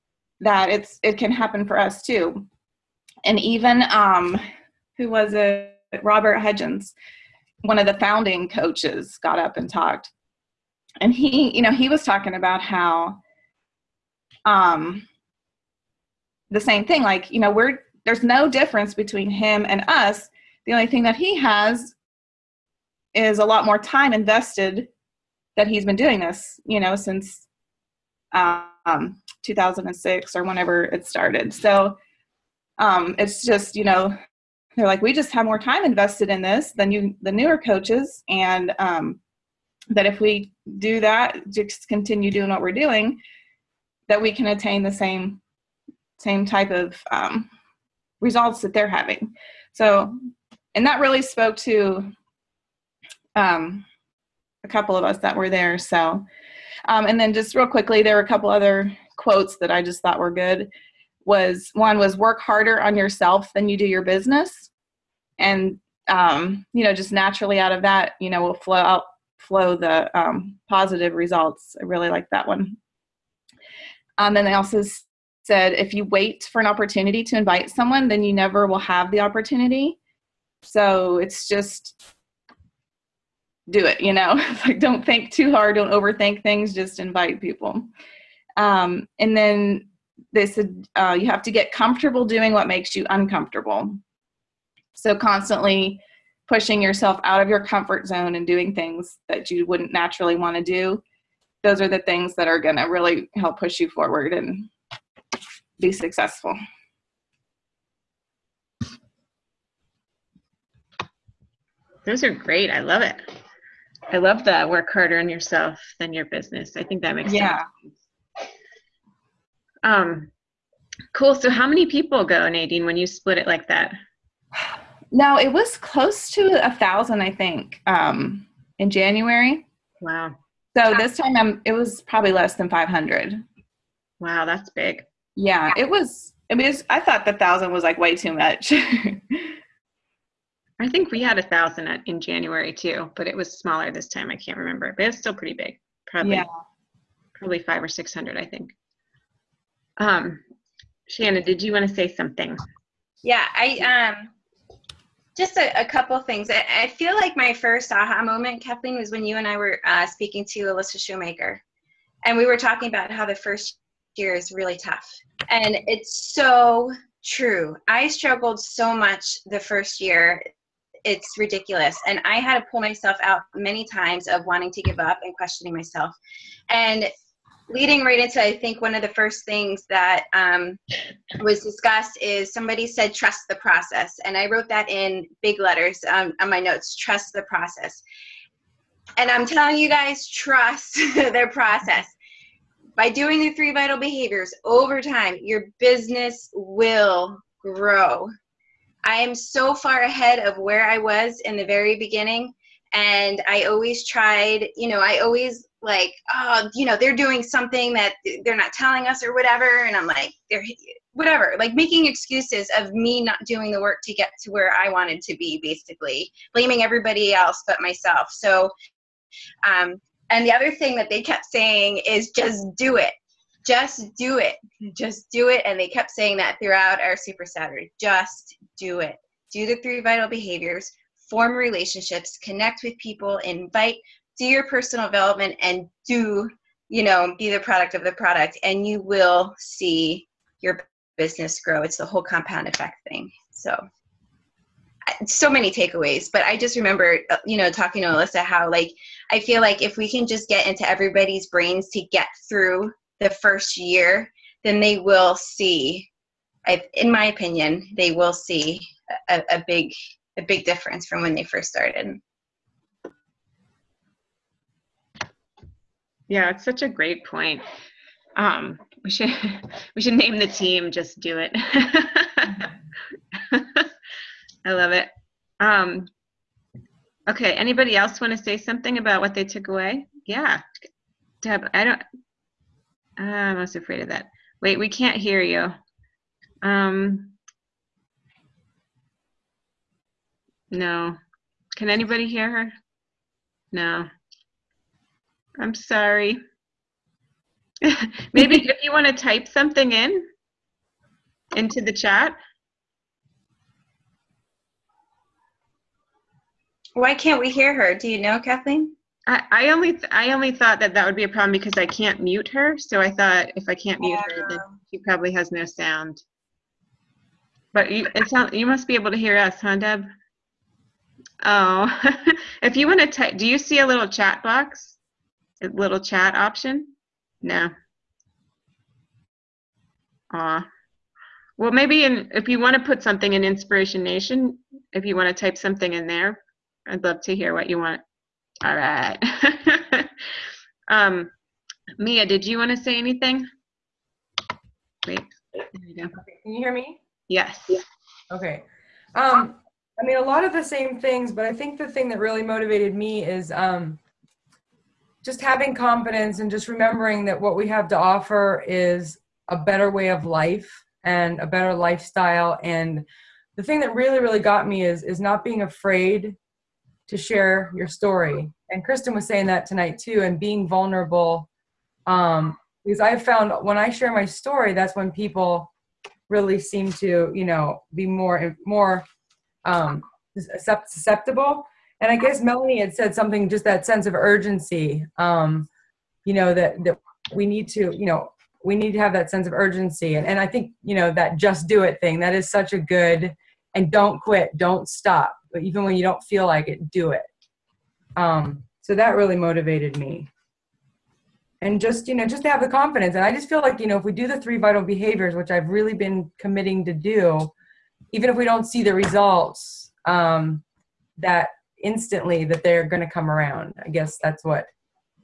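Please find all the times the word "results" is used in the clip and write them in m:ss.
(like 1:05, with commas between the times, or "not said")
0:48, 1:11, 6:48.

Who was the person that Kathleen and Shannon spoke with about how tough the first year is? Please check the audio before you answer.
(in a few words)
Alyssa Shoemaker.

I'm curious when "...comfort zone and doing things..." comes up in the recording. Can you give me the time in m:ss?
1:37.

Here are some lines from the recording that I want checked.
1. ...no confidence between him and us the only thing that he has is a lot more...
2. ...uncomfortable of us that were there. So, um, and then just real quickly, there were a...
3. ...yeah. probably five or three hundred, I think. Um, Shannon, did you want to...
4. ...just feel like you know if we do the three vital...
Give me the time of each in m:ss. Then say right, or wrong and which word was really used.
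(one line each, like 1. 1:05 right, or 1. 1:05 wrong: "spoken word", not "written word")
1. 0:18 wrong: "difference", not "confidence"
2. 0:54 wrong: "couple", not "uncomfortable"
3. 2:26 wrong: "six", not "three"
4. 6:43 right.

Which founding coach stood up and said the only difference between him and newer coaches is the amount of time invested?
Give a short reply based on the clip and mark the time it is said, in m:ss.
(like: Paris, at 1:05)
Robert Hudgens, at 0:06.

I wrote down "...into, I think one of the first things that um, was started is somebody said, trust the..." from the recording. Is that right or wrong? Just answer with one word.
wrong.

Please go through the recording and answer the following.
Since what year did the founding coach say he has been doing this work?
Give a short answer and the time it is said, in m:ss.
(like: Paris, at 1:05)
2006, at 0:29.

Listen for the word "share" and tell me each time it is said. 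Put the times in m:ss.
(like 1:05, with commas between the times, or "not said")
6:07, 6:13.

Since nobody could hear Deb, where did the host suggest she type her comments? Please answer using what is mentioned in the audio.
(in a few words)
Inspiration Nation.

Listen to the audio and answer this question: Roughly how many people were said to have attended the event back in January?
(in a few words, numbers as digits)
1000.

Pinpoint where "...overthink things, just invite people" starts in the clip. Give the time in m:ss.
1:25.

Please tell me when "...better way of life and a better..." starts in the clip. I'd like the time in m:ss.
5:59.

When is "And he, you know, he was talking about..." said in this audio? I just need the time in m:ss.
0:11.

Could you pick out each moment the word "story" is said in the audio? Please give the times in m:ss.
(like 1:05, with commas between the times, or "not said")
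6:07, 6:14.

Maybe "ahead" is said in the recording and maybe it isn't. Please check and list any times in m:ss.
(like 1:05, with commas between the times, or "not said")
3:20.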